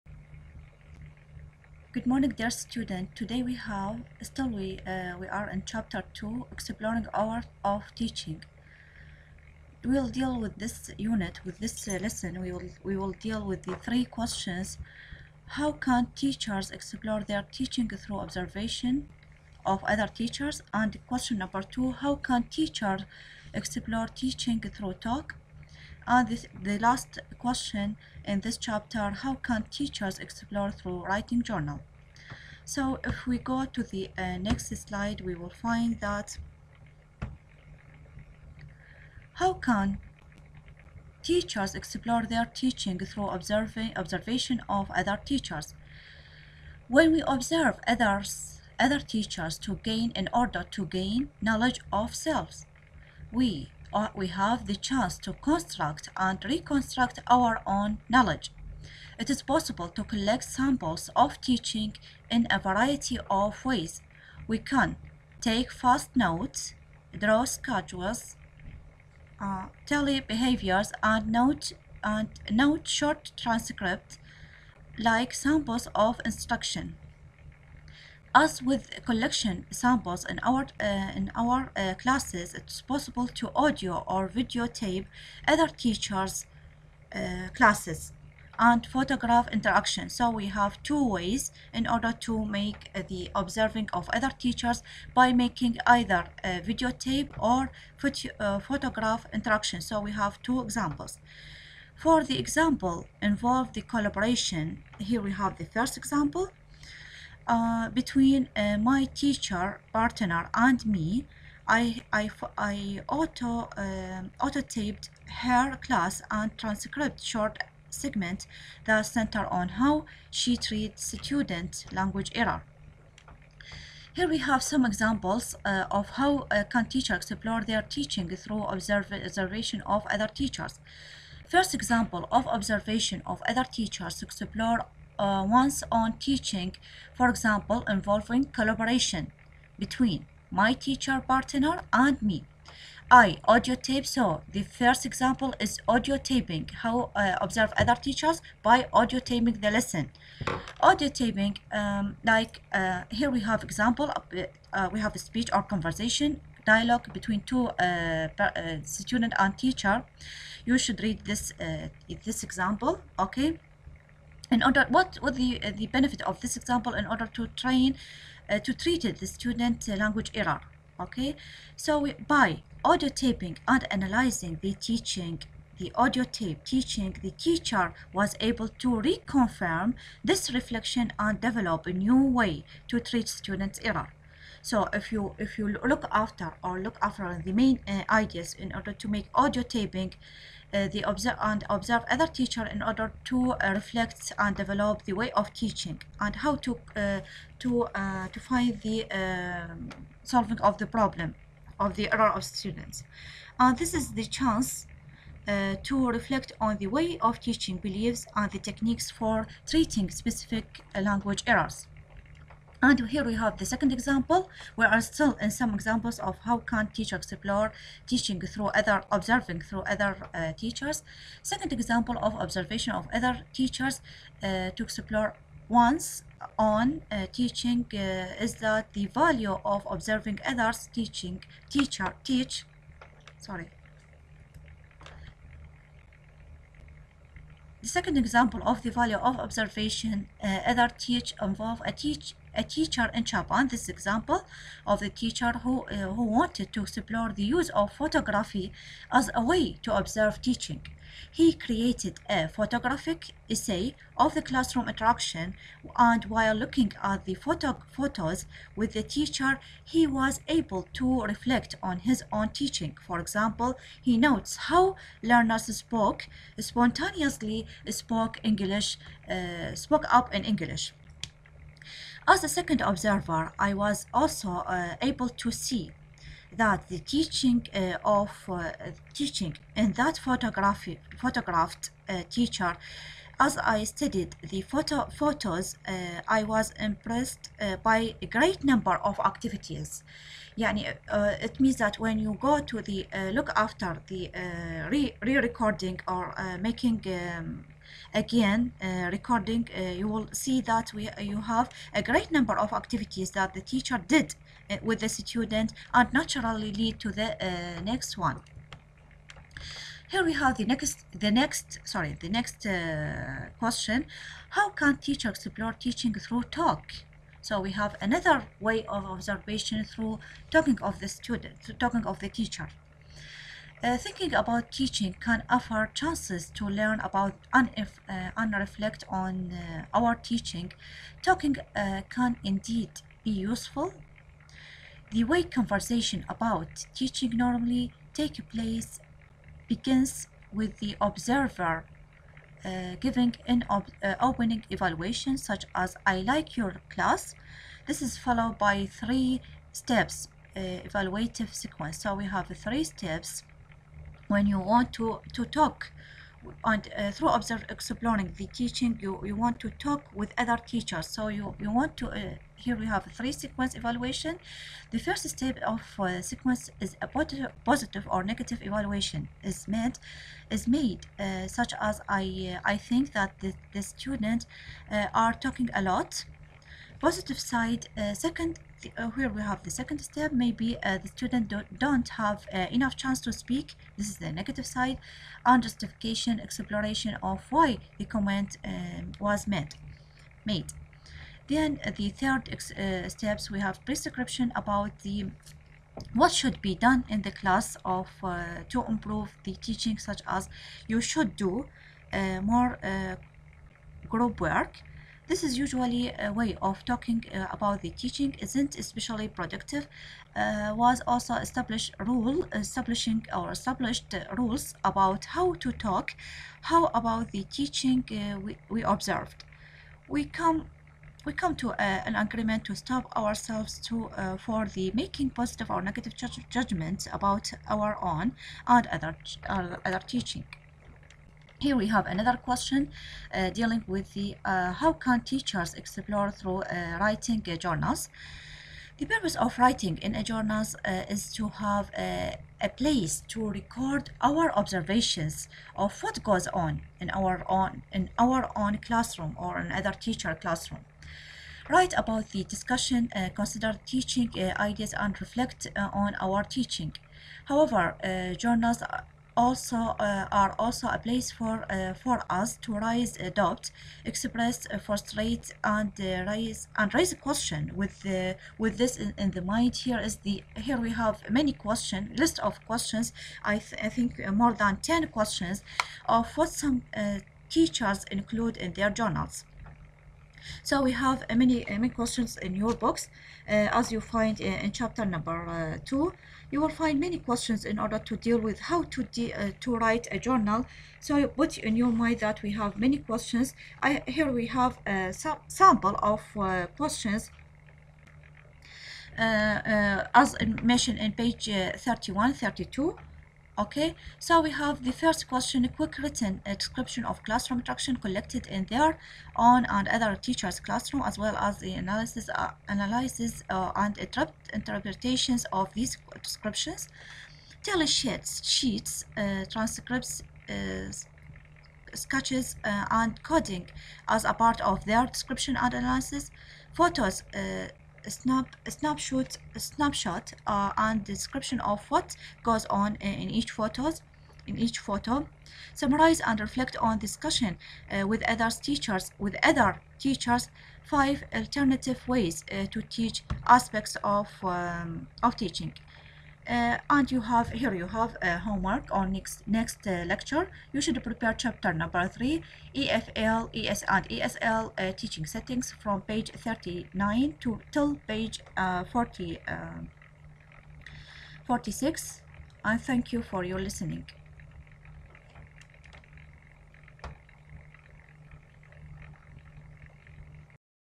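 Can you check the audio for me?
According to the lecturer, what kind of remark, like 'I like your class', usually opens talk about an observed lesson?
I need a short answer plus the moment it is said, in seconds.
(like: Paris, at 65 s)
Opening evaluation, at 344 s.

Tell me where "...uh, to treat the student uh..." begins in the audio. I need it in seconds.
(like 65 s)
168 s.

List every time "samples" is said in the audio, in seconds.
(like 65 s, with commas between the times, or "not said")
60 s, 75 s, 79 s, 495 s.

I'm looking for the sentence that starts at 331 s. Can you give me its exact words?
Talking uh, can indeed be useful.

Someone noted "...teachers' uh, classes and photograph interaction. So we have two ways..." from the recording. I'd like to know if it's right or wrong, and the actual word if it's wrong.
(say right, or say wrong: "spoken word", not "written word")
right.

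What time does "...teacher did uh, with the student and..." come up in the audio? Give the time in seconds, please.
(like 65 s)
303 s.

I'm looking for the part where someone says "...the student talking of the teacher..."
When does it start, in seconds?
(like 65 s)
320 s.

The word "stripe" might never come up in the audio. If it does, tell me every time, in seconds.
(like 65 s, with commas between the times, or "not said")
not said.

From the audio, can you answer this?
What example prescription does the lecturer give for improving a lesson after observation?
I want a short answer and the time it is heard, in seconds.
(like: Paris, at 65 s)
Do more group work, at 401 s.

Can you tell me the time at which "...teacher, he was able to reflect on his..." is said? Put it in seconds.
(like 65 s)
259 s.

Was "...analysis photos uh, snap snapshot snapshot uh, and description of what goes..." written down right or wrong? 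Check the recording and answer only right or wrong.
right.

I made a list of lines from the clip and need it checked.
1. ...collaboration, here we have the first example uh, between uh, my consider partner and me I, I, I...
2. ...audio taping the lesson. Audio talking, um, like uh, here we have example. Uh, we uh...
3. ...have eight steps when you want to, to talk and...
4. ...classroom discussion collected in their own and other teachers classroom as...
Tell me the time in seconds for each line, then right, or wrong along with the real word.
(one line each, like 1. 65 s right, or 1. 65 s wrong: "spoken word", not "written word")
1. 103 s wrong: "teacher", not "consider"
2. 148 s wrong: "taping", not "talking"
3. 352 s wrong: "three", not "eight"
4. 507 s wrong: "interaction", not "discussion".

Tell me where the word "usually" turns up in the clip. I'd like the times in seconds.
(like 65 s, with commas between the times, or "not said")
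405 s.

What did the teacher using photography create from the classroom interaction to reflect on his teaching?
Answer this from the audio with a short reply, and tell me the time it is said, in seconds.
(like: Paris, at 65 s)
A photographic essay, at 252 s.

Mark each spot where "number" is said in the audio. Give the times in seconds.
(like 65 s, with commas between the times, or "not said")
21 s, 288 s, 302 s, 485 s, 551 s.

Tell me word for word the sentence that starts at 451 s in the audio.
Write about the discussion, uh, consider teaching ideas, and reflect on our teaching.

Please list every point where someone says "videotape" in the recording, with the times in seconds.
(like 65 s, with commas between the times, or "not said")
84 s, 96 s.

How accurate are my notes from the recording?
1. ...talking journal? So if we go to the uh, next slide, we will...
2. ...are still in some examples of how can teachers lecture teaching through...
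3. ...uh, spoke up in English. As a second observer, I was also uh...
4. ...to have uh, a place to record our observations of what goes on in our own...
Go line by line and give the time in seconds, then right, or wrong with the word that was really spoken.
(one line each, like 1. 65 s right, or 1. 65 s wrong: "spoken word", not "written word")
1. 31 s wrong: "writing", not "talking"
2. 214 s wrong: "explore", not "lecture"
3. 269 s right
4. 441 s right.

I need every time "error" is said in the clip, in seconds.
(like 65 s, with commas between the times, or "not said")
122 s, 170 s, 183 s, 202 s, 211 s.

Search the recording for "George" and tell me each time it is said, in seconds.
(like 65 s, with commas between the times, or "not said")
not said.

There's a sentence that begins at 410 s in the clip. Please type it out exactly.
Uh, was also established rule establishing or established rules about how to talk, how about the teaching uh, we, we observed.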